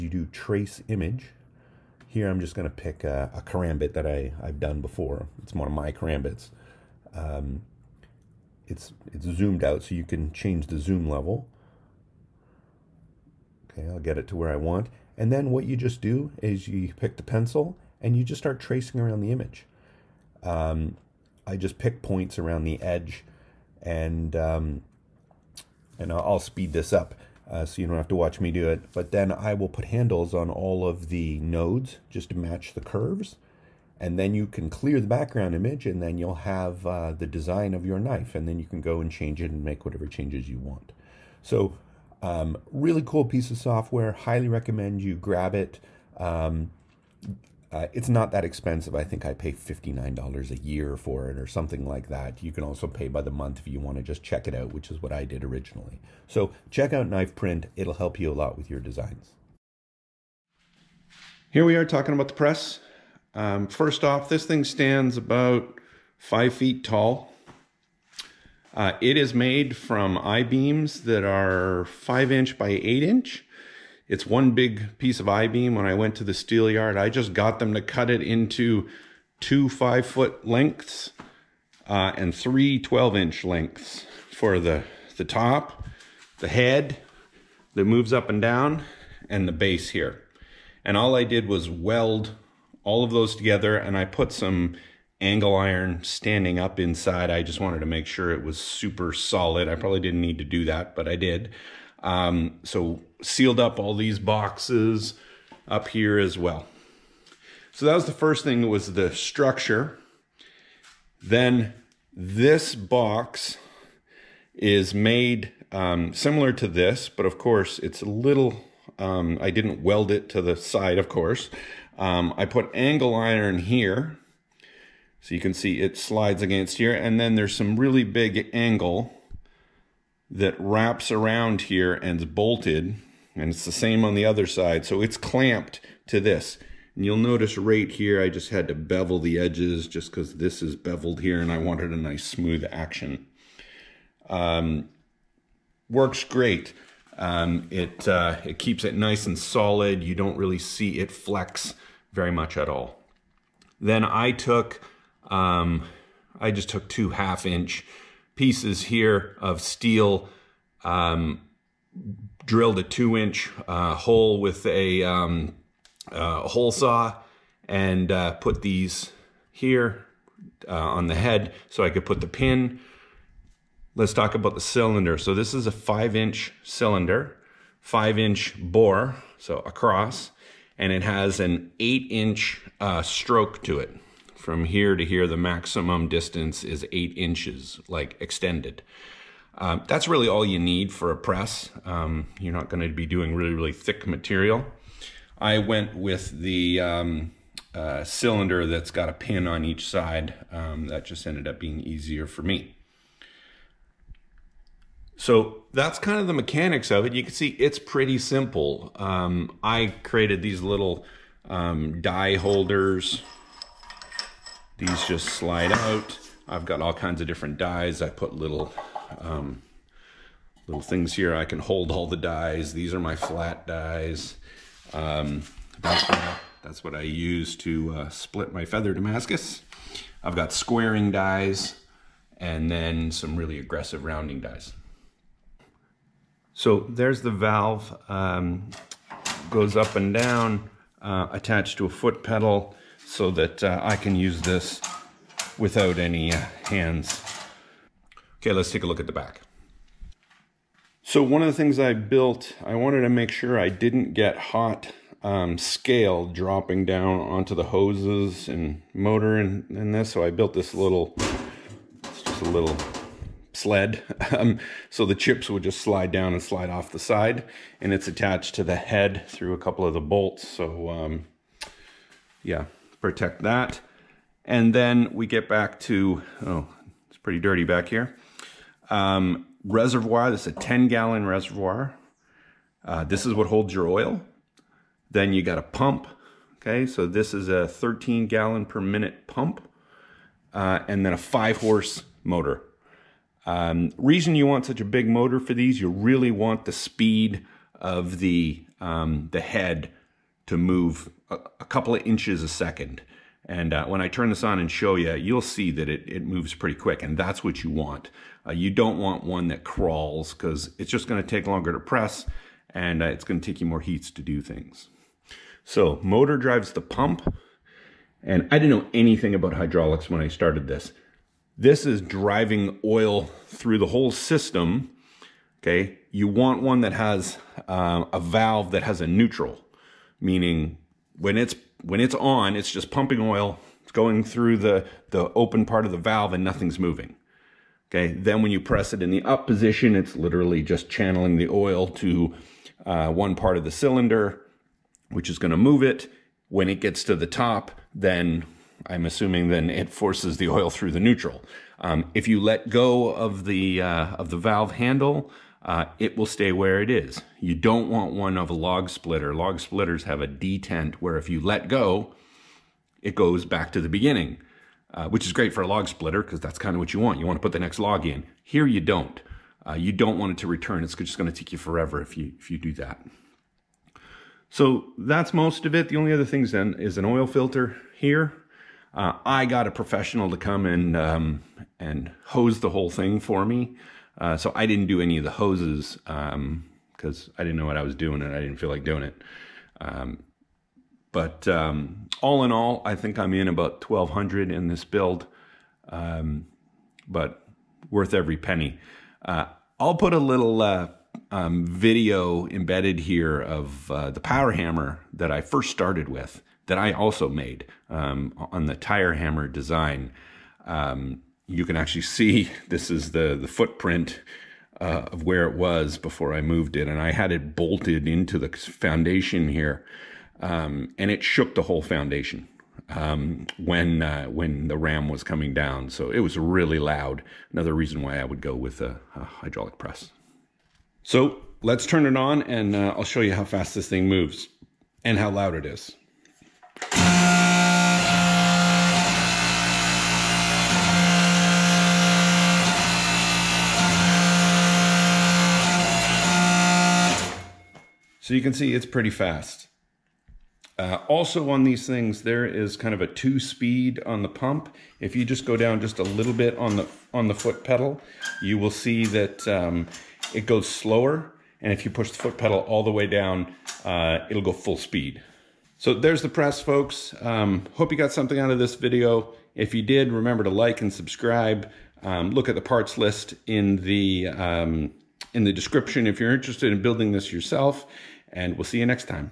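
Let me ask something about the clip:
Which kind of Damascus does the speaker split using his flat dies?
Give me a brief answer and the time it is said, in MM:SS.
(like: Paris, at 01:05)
feather Damascus, at 03:48.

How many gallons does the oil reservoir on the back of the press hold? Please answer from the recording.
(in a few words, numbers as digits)
10 gallons.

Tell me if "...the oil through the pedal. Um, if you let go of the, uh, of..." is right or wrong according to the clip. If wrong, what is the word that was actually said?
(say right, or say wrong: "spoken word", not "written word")
wrong: "neutral", not "pedal".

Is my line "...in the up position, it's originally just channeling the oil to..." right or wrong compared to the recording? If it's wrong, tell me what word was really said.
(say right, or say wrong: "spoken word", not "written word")
wrong: "literally", not "originally".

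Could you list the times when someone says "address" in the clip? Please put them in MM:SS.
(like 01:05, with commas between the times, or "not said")
not said.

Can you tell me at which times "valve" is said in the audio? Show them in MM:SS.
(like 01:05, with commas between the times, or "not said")
03:57, 05:28, 05:35, 05:54.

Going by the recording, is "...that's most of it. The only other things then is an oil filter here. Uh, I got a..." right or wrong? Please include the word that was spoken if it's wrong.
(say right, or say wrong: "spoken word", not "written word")
right.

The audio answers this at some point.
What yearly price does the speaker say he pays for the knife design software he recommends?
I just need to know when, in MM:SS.
00:49.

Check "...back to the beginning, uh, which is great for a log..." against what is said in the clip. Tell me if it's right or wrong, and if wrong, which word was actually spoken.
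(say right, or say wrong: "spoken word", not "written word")
right.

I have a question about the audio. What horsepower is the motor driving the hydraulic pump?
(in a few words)
5 horsepower.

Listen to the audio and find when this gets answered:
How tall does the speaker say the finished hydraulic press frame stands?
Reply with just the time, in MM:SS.
01:06.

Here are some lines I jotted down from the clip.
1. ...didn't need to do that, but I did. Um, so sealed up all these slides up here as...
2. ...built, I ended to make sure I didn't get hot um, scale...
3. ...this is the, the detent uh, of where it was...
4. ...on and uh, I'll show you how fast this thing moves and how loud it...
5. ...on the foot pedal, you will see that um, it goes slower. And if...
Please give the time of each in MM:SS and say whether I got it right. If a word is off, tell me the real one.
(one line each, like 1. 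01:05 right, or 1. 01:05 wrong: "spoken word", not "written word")
1. 01:39 wrong: "boxes", not "slides"
2. 04:11 wrong: "wanted", not "ended"
3. 06:52 wrong: "footprint", not "detent"
4. 07:12 right
5. 07:37 right.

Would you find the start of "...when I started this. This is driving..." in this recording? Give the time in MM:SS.
05:20.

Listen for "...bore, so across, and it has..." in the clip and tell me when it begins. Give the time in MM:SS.
02:58.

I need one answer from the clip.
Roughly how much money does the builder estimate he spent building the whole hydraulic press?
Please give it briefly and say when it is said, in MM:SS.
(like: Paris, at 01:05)
1,200, at 06:33.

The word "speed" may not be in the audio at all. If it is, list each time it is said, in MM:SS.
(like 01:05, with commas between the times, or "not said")
00:26, 04:56, 07:33, 07:44.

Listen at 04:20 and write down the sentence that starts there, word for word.
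So I built this little, it's just a little sled.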